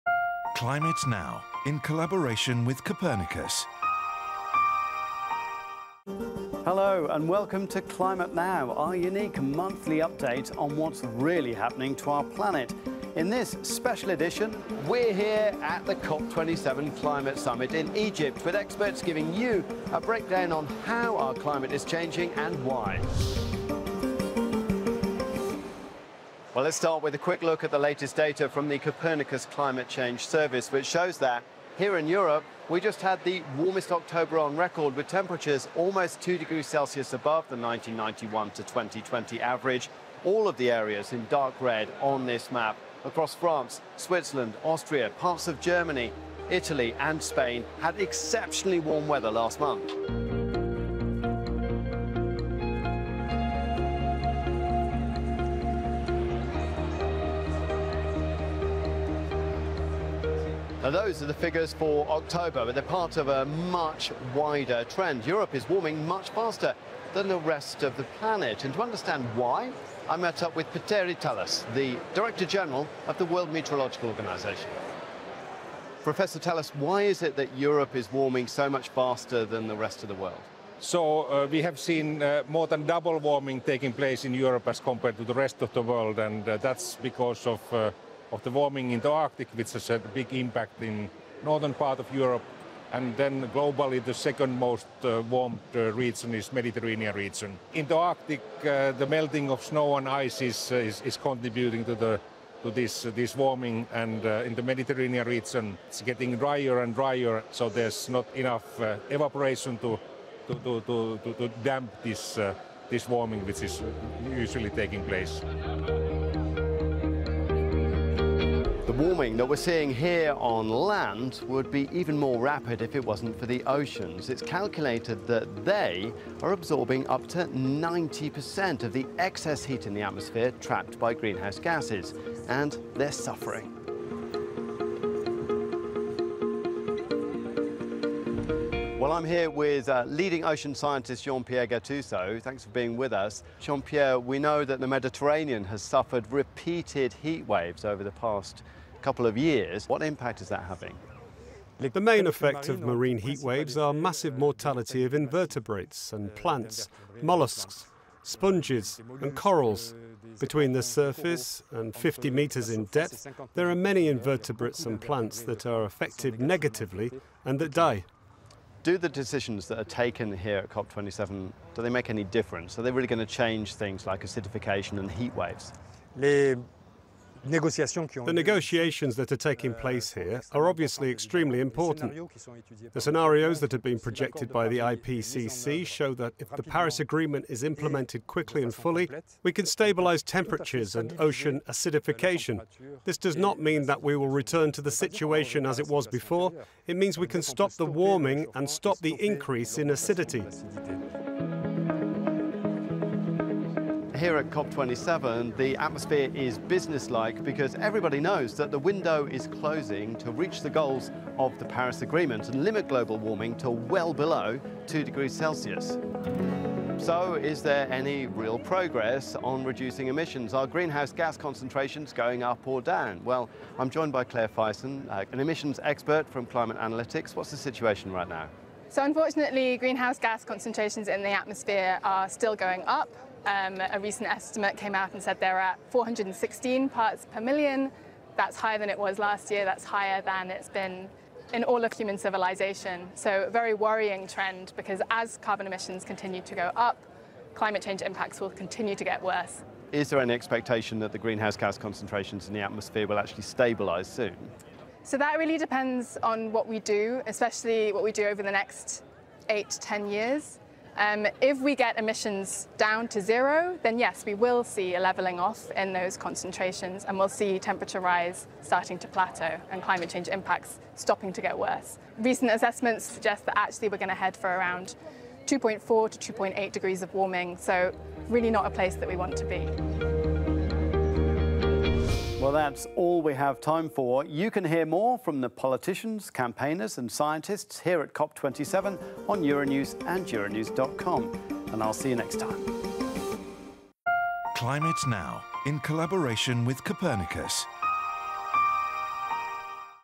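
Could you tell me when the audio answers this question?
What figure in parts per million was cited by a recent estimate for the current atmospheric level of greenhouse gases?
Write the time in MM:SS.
03:55.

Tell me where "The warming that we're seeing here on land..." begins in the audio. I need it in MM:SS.
01:58.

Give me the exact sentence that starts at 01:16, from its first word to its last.
Professor Taalas, why is it that Europe is warming so much faster than the rest of the world?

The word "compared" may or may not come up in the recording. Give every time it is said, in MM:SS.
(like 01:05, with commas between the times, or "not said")
01:24.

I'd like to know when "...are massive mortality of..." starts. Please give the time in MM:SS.
02:33.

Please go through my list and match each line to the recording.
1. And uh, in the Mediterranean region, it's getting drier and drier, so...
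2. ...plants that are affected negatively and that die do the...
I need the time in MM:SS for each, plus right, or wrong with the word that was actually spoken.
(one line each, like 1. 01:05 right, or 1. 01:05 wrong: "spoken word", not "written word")
1. 01:43 right
2. 02:45 right.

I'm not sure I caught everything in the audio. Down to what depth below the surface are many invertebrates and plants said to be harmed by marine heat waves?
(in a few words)
50 meters.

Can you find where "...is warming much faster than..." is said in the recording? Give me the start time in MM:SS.
01:05.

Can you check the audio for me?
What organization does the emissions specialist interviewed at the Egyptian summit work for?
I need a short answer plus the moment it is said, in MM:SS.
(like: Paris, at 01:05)
Climate Analytics, at 03:46.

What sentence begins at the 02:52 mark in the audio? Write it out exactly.
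Are they really going to change things like acidification and heat waves?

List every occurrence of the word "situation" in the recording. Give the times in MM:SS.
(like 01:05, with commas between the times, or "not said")
03:14, 03:47.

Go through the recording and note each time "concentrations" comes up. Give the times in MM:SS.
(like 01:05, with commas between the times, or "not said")
03:41, 03:50, 04:11, 04:26.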